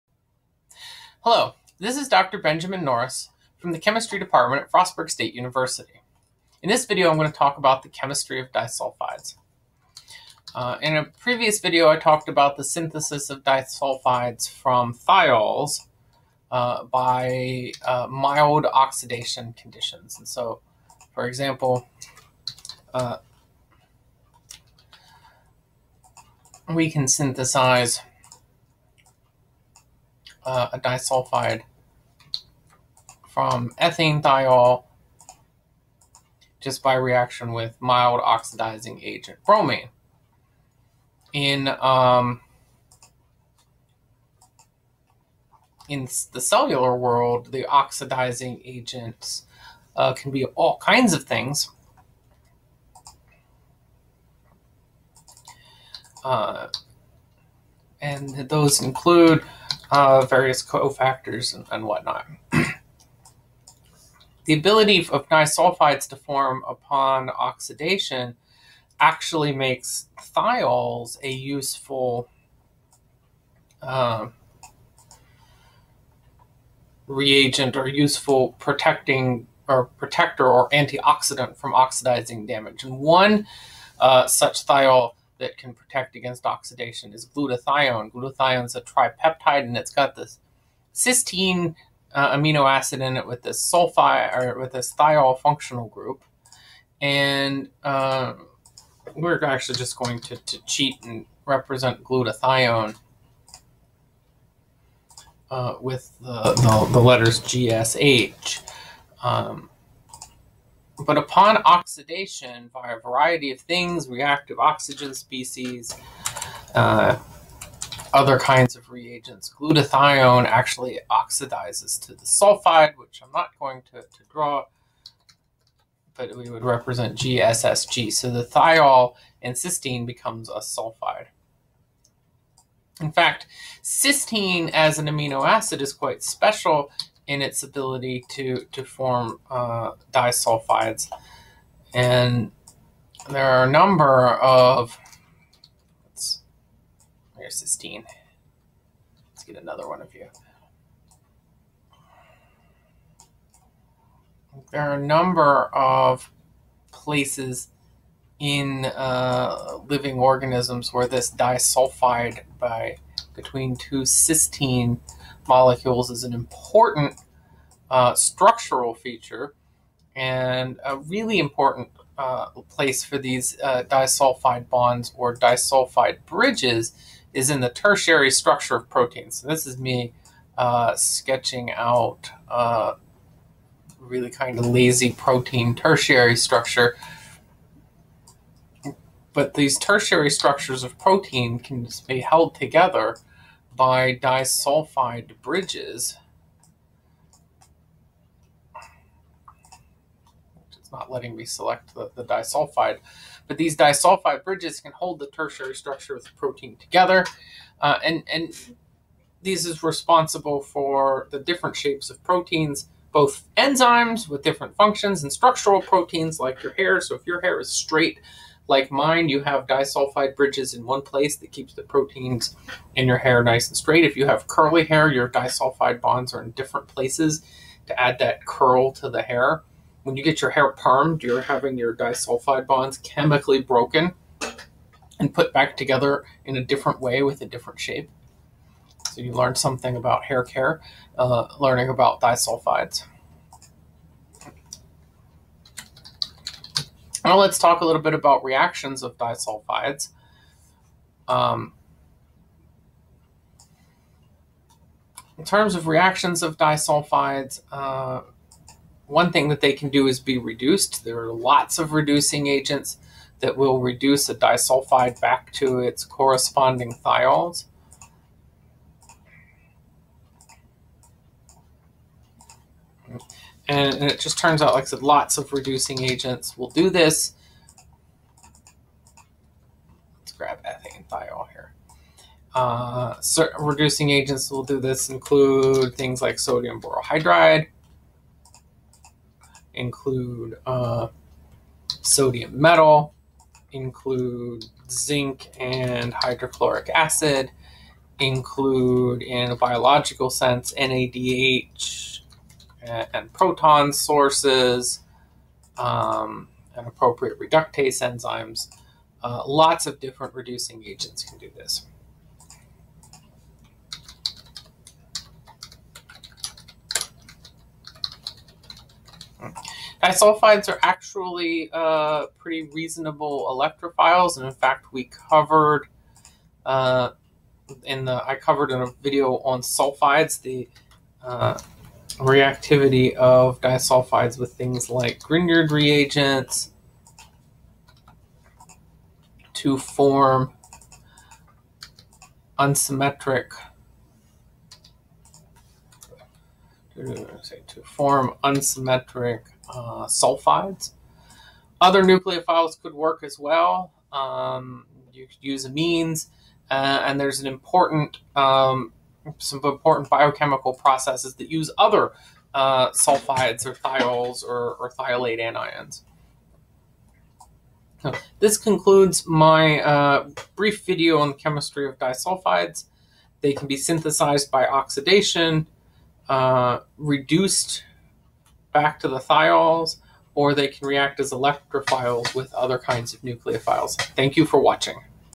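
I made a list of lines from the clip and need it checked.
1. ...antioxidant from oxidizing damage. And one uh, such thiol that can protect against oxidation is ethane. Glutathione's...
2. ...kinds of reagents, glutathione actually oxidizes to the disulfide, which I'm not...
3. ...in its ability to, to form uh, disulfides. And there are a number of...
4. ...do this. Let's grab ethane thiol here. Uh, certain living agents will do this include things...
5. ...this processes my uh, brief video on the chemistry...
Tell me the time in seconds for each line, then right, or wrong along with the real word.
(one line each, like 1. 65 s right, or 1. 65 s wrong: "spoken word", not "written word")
1. 80 s wrong: "glutathione", not "ethane"
2. 118 s wrong: "sulfide", not "disulfide"
3. 137 s right
4. 276 s wrong: "reducing", not "living"
5. 368 s wrong: "concludes", not "processes".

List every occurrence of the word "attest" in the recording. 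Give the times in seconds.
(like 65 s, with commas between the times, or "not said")
not said.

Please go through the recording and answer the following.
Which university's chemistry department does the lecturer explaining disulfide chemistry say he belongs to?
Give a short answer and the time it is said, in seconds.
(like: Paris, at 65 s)
Frostburg State University, at 4 s.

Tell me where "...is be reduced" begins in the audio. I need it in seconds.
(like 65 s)
260 s.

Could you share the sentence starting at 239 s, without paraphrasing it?
So you learn something about hair care, uh, learning about disulfides.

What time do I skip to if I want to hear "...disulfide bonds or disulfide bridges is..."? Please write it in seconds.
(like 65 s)
173 s.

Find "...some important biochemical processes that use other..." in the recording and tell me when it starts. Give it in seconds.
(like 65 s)
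359 s.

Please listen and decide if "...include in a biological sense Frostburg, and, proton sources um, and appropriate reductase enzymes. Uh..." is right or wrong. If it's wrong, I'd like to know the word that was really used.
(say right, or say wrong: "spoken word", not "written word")
wrong: "NADH", not "Frostburg".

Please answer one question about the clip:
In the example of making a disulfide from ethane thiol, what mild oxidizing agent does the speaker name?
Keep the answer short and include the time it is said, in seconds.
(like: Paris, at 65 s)
Bromine, at 39 s.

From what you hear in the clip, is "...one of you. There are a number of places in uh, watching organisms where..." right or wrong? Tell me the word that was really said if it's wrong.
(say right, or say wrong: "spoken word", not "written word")
wrong: "living", not "watching".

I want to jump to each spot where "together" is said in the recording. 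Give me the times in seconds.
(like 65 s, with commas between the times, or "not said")
192 s, 206 s, 235 s.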